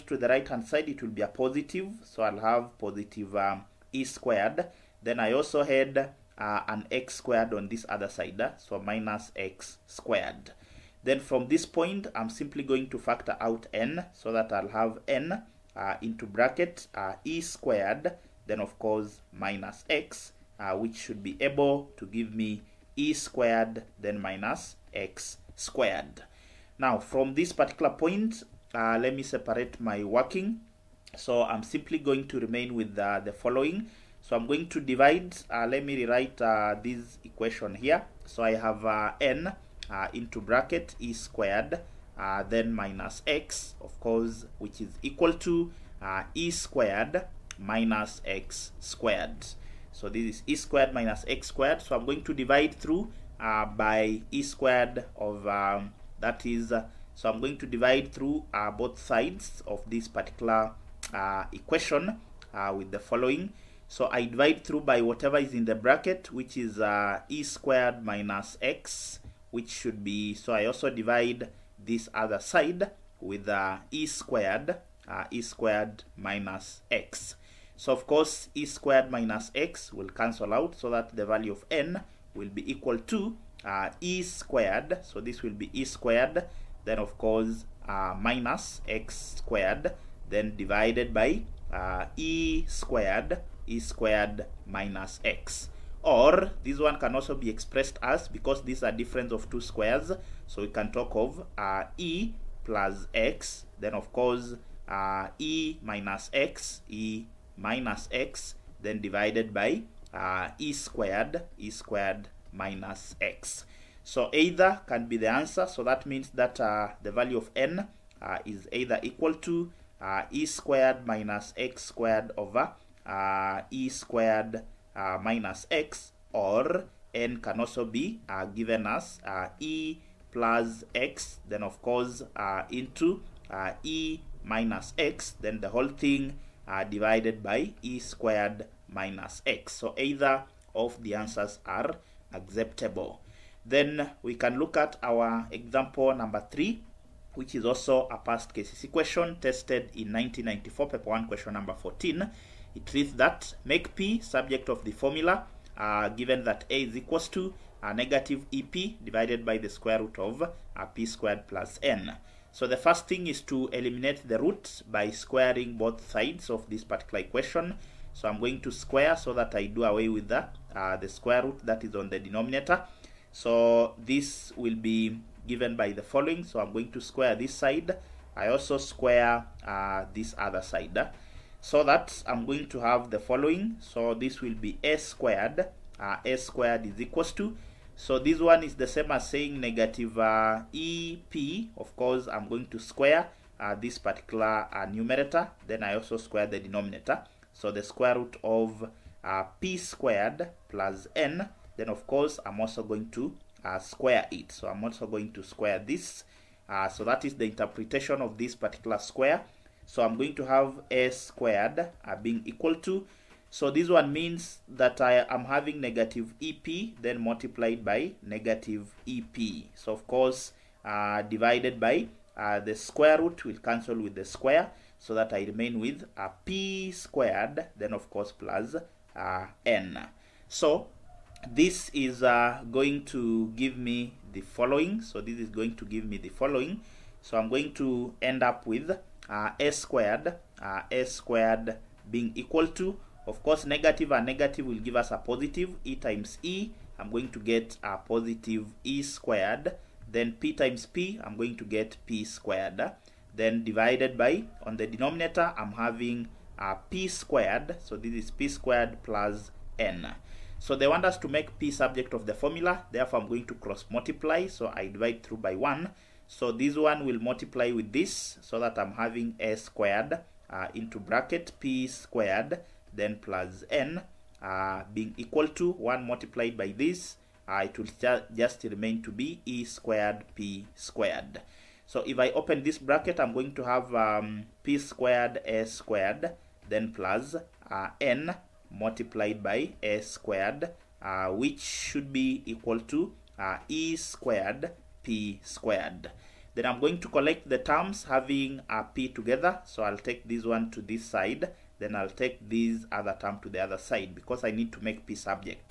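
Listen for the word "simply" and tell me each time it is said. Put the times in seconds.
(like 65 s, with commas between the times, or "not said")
12 s, 31 s.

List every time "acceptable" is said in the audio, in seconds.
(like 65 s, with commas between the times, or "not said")
142 s.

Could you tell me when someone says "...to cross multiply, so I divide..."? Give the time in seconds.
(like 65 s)
263 s.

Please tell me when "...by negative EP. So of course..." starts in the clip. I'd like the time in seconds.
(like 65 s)
217 s.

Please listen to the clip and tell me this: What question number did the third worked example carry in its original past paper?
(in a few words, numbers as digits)
14.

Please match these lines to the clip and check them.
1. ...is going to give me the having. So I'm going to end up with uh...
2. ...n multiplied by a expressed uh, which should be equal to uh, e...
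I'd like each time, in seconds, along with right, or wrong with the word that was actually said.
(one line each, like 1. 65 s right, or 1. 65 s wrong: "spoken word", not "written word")
1. 235 s wrong: "following", not "having"
2. 287 s wrong: "squared", not "expressed".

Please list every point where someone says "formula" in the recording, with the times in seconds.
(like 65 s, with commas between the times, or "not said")
154 s, 262 s.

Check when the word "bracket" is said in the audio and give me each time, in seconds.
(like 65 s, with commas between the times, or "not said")
16 s, 40 s, 65 s, 270 s, 282 s.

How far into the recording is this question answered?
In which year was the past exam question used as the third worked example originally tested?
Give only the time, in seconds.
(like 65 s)
150 s.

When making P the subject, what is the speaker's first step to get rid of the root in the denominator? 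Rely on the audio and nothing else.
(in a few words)
Squaring both sides.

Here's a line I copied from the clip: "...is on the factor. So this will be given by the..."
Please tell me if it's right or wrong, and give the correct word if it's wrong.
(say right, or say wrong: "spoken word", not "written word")
wrong: "denominator", not "factor".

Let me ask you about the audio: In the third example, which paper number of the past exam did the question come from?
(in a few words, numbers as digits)
Paper one.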